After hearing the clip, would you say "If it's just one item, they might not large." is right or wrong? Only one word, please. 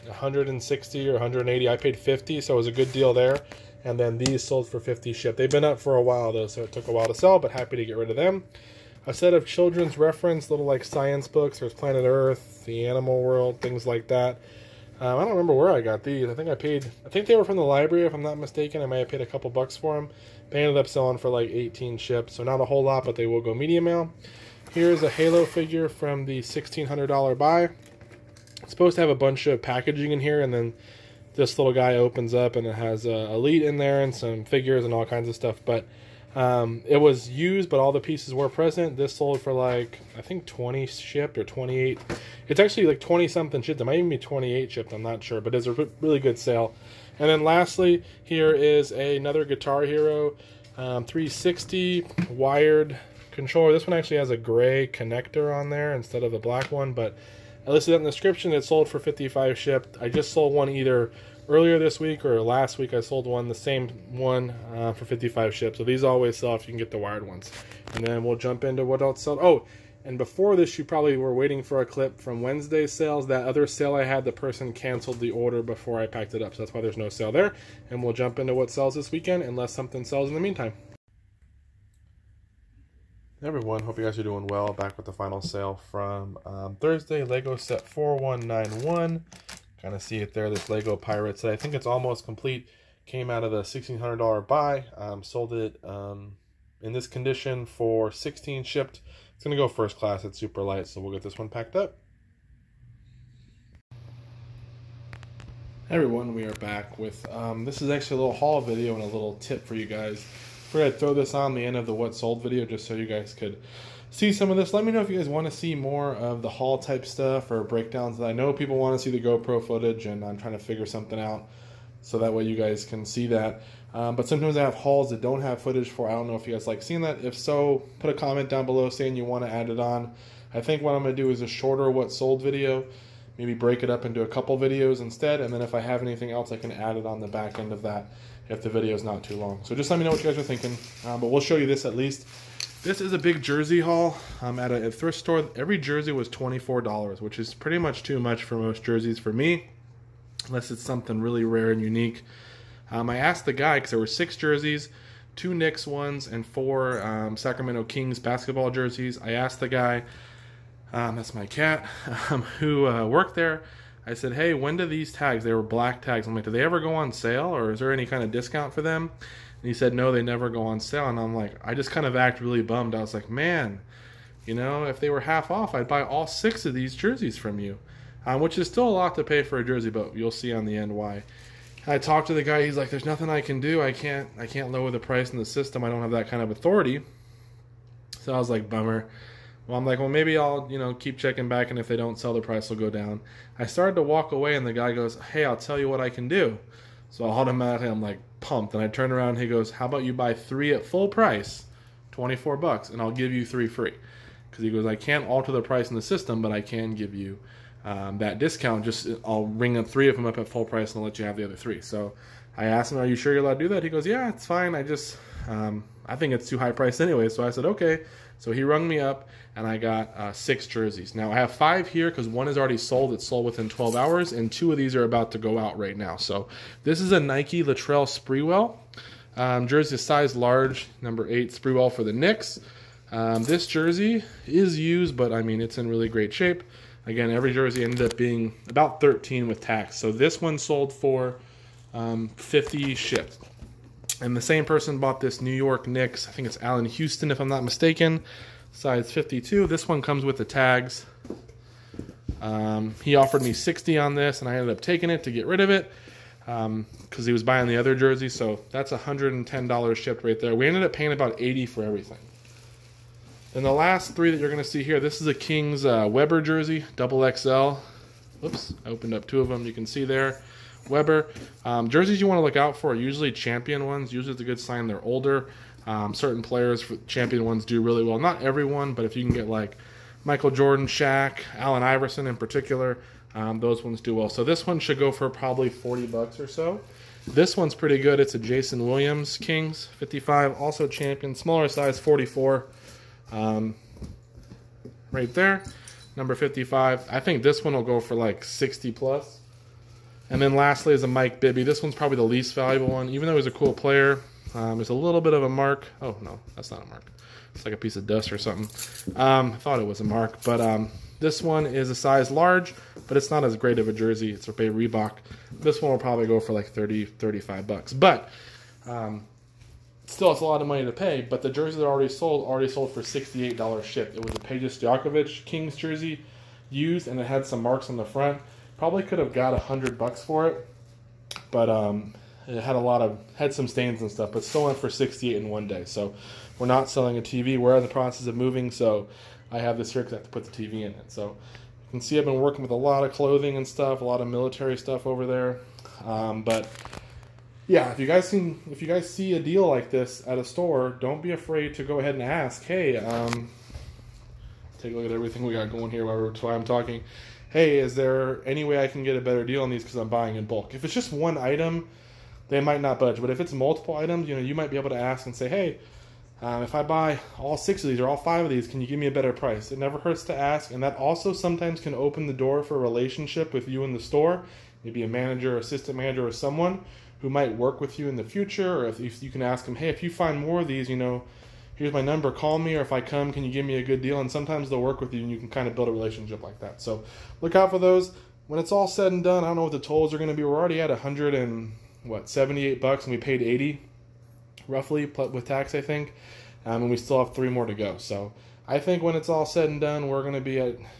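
wrong.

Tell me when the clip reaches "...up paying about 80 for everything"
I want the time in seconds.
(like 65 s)
260 s.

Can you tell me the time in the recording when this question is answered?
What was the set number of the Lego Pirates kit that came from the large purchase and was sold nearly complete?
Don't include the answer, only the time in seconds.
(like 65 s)
87 s.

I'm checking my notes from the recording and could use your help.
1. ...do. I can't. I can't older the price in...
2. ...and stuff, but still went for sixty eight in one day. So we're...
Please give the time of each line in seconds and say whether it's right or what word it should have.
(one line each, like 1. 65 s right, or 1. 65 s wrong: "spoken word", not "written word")
1. 183 s wrong: "lower", not "older"
2. 334 s right.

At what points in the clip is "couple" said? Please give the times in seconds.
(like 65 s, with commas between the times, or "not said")
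19 s, 134 s.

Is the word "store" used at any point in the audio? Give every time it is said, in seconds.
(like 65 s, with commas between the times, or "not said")
145 s, 350 s, 373 s.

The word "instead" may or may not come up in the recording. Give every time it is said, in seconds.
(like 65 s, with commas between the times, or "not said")
55 s, 134 s.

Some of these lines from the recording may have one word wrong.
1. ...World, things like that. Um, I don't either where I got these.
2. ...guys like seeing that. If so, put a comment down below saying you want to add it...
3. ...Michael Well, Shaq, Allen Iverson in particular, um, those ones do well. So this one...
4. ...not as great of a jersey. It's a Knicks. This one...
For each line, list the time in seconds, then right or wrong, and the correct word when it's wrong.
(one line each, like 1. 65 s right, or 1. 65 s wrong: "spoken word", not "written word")
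1. 13 s wrong: "remember", not "either"
2. 126 s right
3. 280 s wrong: "Jordan", not "Well"
4. 313 s wrong: "Reebok", not "Knicks".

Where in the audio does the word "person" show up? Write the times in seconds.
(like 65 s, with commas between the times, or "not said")
74 s, 244 s.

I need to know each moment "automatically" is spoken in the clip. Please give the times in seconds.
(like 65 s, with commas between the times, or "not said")
197 s.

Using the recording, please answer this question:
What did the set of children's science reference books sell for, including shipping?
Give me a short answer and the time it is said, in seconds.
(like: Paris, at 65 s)
18, at 21 s.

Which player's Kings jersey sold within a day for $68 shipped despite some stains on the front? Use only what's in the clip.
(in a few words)
Peja Stojakovic.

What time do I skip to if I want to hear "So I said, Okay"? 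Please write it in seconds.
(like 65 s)
217 s.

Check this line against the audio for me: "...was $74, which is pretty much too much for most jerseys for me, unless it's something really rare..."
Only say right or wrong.
wrong.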